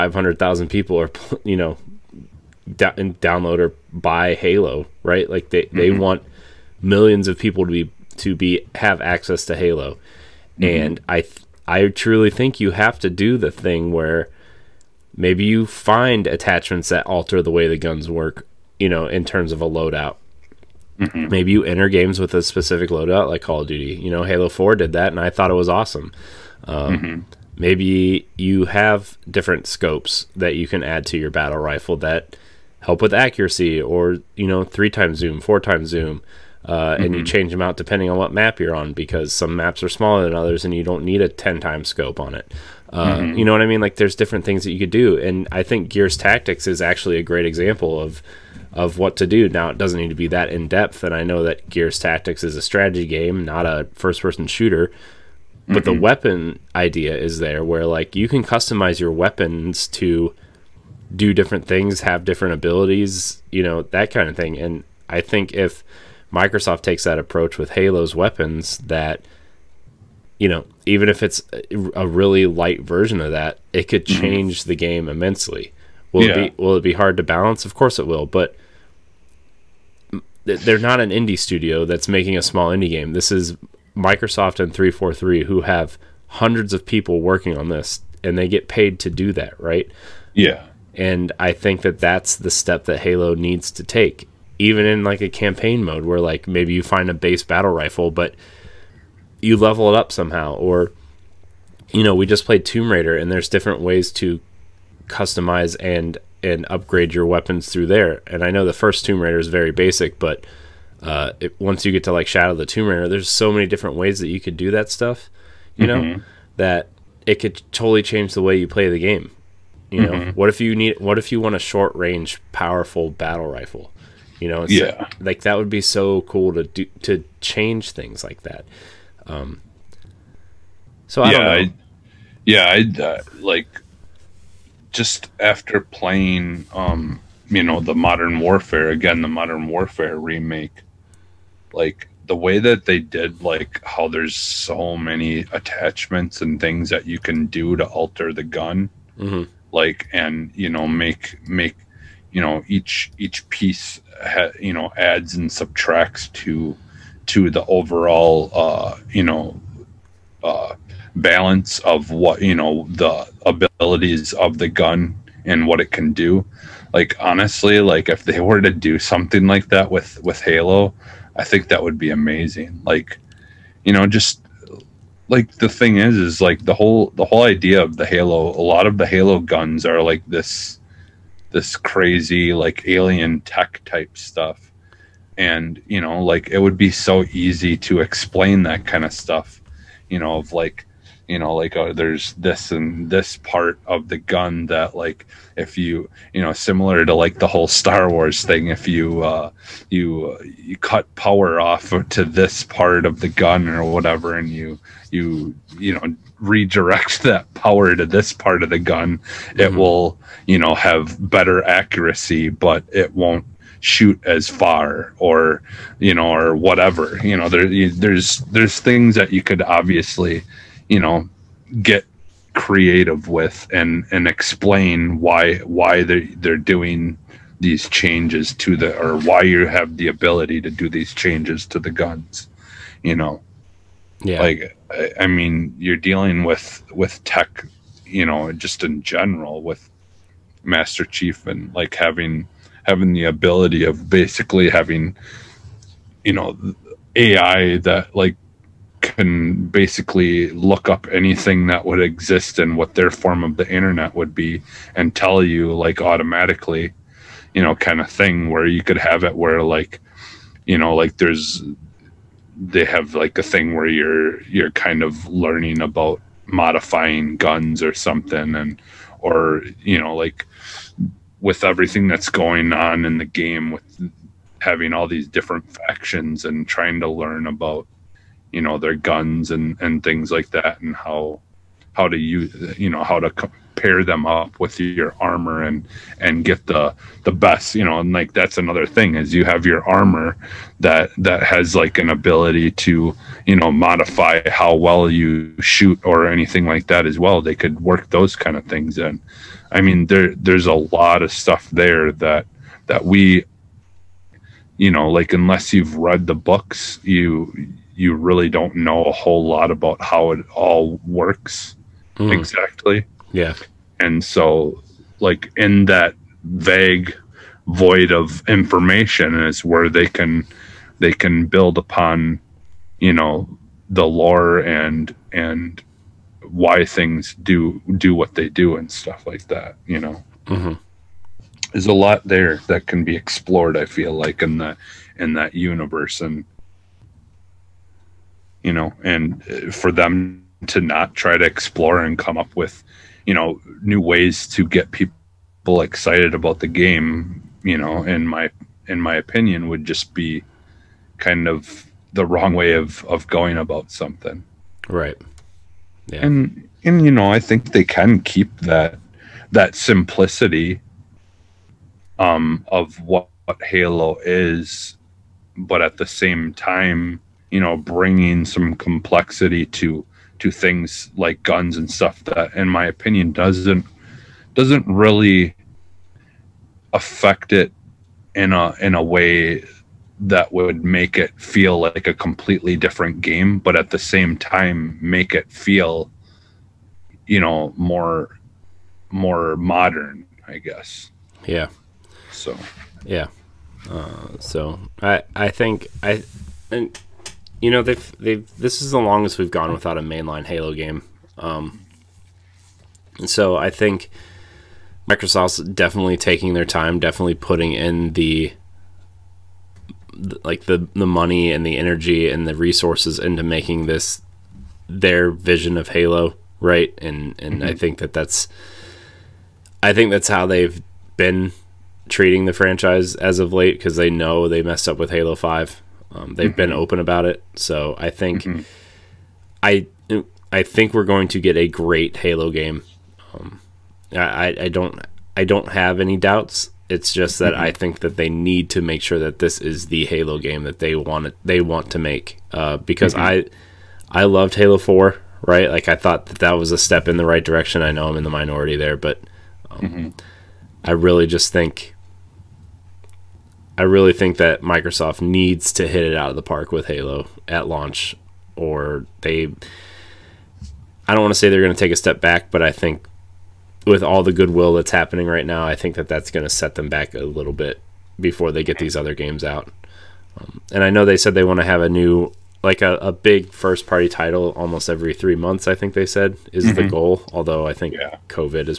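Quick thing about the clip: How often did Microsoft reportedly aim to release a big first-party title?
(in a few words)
every 3 months.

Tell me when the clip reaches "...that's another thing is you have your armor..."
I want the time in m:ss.
4:48.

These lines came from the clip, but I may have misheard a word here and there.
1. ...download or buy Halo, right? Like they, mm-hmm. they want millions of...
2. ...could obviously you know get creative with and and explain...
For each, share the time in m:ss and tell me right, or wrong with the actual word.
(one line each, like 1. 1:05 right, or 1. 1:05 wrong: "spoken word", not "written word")
1. 0:02 right
2. 3:39 right.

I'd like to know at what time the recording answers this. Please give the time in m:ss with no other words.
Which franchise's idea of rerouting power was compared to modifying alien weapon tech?
3:17.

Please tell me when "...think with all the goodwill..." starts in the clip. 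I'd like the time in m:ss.
7:42.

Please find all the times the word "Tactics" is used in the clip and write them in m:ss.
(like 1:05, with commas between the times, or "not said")
0:46, 0:51.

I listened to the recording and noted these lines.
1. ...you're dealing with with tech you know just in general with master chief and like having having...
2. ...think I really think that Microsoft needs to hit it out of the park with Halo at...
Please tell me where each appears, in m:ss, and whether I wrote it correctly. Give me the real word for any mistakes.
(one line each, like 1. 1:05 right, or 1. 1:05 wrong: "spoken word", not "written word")
1. 3:55 right
2. 7:31 right.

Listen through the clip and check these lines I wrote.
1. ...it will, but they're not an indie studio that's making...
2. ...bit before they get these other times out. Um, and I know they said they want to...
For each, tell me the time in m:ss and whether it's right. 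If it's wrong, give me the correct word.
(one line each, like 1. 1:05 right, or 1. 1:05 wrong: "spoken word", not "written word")
1. 1:17 right
2. 7:47 wrong: "games", not "times".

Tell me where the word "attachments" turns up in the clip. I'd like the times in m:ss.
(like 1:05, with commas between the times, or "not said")
0:16, 2:25.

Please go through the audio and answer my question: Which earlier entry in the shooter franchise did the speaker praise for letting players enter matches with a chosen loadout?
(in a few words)
Halo 4.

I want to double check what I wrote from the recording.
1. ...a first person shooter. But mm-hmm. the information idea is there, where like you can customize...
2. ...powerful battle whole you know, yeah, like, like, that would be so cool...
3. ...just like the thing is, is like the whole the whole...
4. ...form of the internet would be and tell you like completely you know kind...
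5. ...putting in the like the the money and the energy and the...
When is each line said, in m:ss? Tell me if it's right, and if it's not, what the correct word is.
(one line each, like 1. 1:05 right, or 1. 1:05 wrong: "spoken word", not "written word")
1. 0:53 wrong: "weapon", not "information"
2. 2:02 wrong: "rifle", not "whole"
3. 2:54 right
4. 4:13 wrong: "automatically", not "completely"
5. 6:47 right.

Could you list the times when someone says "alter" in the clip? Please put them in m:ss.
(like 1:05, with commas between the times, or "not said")
0:17, 2:27.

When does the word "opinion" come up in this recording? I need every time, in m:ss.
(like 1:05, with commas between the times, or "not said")
5:49, 6:12.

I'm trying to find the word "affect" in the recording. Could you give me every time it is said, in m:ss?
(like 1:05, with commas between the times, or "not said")
6:16.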